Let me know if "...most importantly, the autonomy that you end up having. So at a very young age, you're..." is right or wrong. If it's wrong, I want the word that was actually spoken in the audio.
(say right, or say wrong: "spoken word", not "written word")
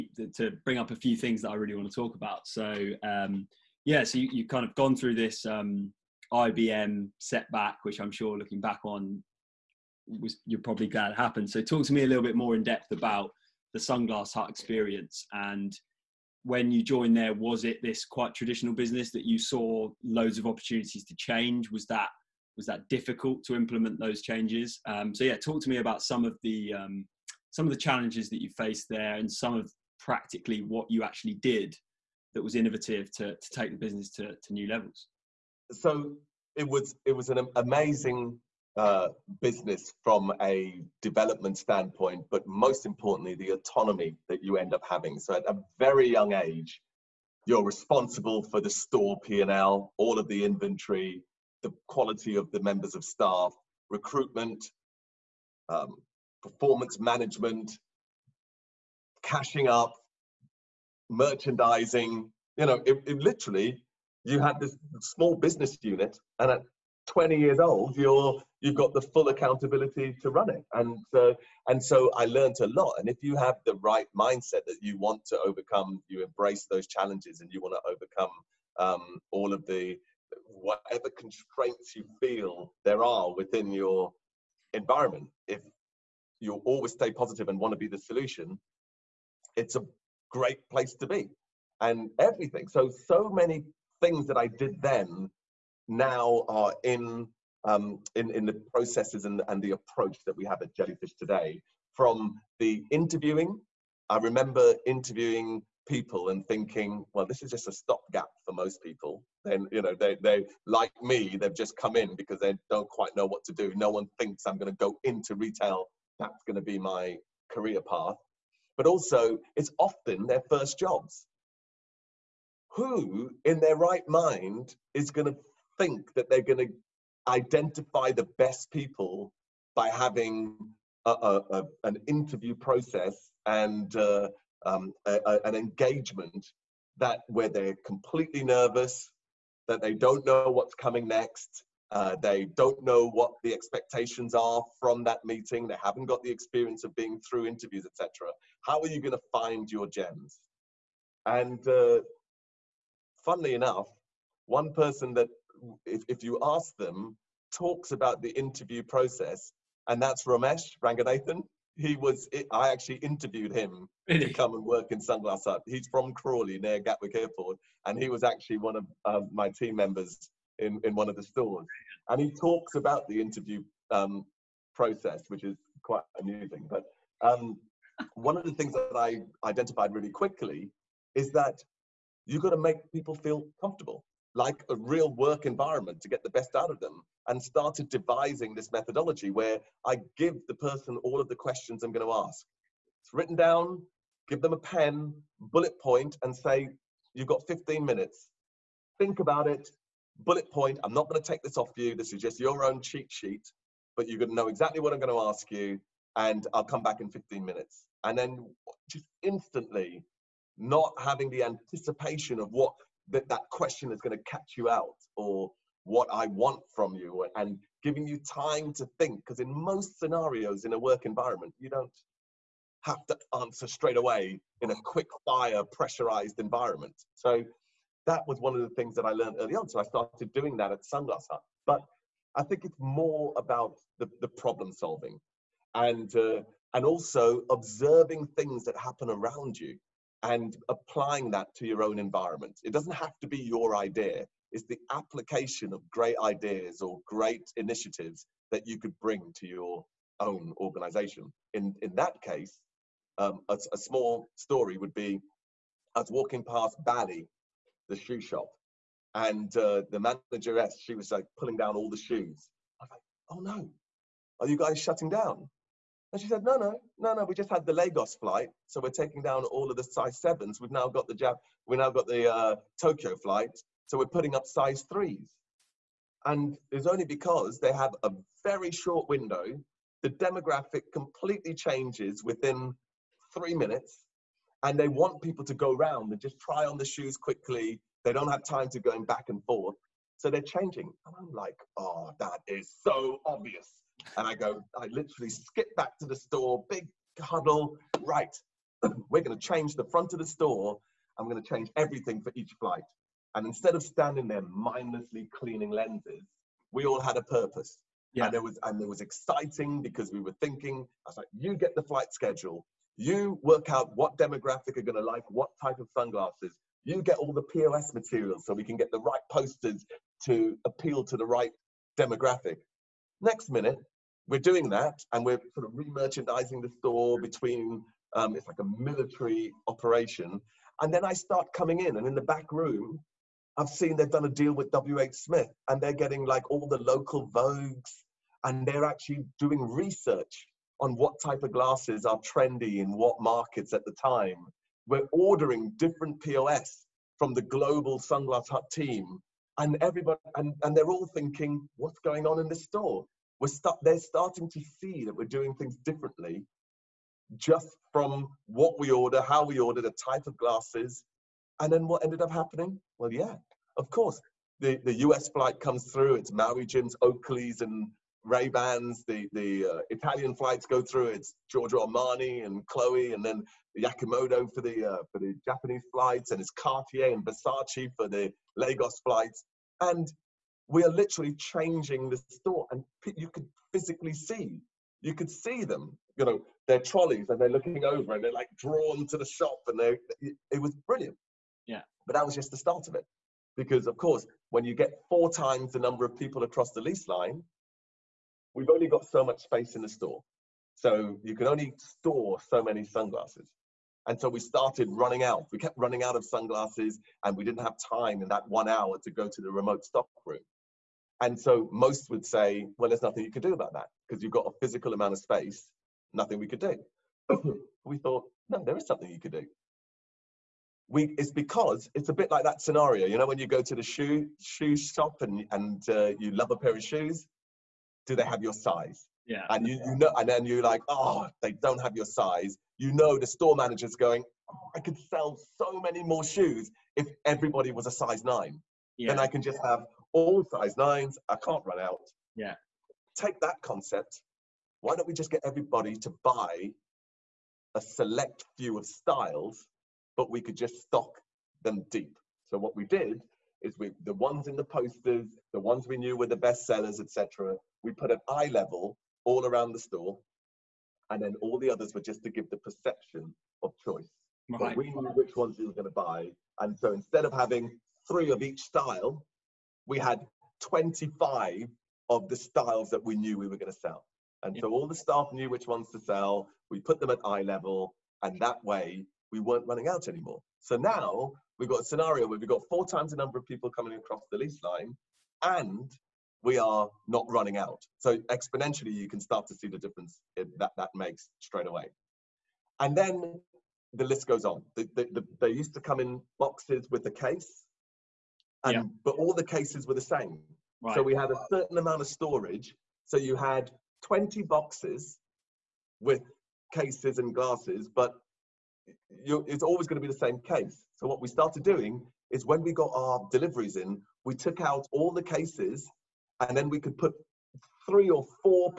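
right.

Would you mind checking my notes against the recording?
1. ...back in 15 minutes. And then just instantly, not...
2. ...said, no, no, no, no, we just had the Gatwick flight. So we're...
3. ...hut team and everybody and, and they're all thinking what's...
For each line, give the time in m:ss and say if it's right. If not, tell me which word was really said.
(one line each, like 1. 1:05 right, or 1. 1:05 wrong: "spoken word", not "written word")
1. 3:26 right
2. 4:26 wrong: "Lagos", not "Gatwick"
3. 5:48 right.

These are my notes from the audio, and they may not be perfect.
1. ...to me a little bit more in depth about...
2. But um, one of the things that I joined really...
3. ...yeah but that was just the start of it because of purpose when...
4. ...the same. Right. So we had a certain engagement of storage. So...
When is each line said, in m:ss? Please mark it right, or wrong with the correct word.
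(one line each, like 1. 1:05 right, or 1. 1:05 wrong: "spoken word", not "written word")
1. 0:11 right
2. 2:56 wrong: "identified", not "joined"
3. 6:31 wrong: "course", not "purpose"
4. 8:19 wrong: "amount", not "engagement".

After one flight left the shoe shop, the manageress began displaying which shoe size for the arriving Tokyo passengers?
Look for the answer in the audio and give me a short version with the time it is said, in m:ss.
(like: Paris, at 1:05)
3, at 4:34.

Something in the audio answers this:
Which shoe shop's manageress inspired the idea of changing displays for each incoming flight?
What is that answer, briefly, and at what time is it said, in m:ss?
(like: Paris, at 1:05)
Bally, at 4:16.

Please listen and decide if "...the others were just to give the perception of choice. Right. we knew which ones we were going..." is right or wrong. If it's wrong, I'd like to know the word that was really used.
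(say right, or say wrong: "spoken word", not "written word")
right.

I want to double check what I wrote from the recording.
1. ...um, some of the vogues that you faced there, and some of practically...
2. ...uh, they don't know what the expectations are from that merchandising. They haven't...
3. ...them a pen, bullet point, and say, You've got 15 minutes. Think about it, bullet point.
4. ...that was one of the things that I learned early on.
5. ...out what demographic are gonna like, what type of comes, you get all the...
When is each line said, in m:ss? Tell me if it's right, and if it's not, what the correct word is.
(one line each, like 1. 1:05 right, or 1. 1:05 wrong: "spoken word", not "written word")
1. 0:26 wrong: "challenges", not "vogues"
2. 2:21 wrong: "meeting", not "merchandising"
3. 3:14 right
4. 3:48 right
5. 5:13 wrong: "sunglasses", not "comes".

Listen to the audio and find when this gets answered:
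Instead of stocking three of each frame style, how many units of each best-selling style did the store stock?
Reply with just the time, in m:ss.
7:50.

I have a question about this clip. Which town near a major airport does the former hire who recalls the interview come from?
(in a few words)
Crawley.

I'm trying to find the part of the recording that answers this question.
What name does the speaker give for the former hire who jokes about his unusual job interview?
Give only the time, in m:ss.
2:40.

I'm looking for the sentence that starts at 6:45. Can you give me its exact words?
We kept running out of sunglasses, and we didn't have time in that one hour to go to the remote stock room.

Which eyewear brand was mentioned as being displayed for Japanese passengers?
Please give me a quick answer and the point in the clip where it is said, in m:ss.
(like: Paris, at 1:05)
Yamamoto, at 6:13.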